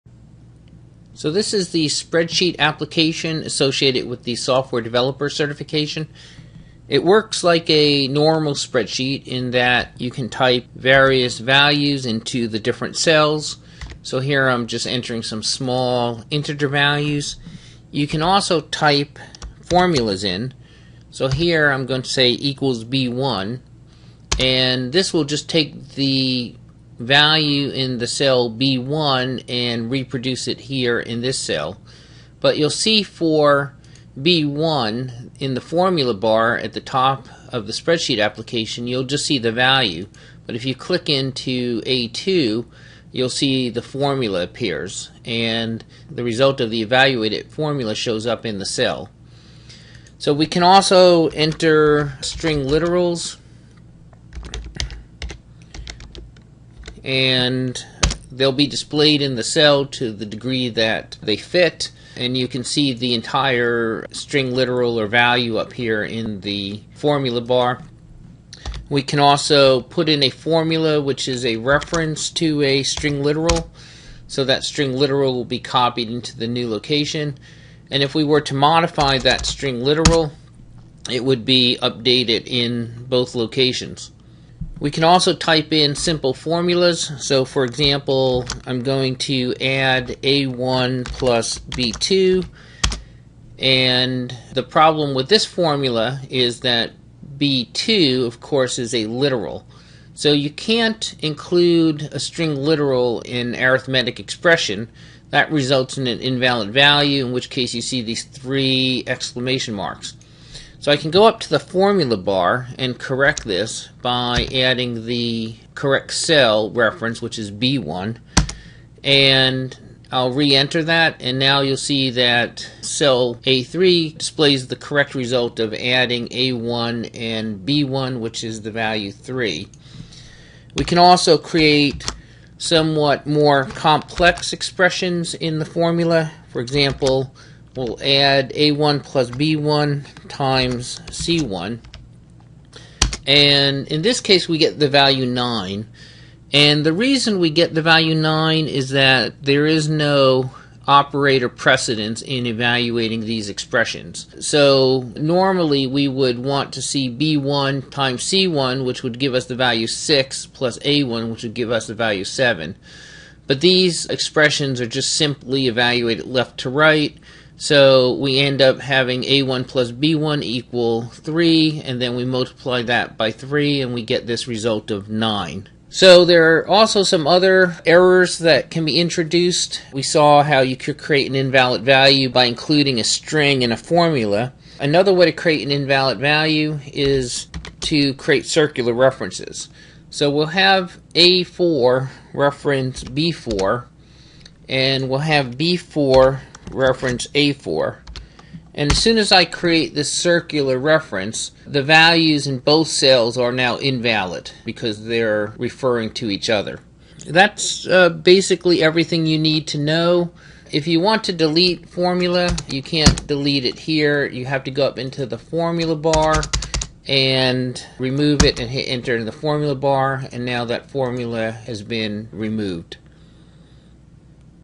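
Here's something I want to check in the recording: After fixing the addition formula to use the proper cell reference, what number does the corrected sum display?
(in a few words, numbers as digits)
3.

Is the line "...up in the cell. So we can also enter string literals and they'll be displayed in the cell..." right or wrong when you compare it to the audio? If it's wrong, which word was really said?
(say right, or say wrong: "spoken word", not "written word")
right.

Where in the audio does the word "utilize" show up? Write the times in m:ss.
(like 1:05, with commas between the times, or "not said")
not said.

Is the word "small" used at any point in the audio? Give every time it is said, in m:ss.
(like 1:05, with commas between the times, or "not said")
0:15.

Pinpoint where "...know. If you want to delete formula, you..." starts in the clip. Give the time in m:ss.
3:29.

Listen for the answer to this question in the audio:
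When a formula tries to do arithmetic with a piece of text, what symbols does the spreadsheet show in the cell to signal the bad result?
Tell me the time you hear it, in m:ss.
1:48.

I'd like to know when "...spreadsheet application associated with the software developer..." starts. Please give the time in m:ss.
0:01.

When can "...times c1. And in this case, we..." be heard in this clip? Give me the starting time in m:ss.
2:20.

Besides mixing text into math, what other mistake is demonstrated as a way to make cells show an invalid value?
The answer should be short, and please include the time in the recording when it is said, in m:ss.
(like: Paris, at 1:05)
circular references, at 3:08.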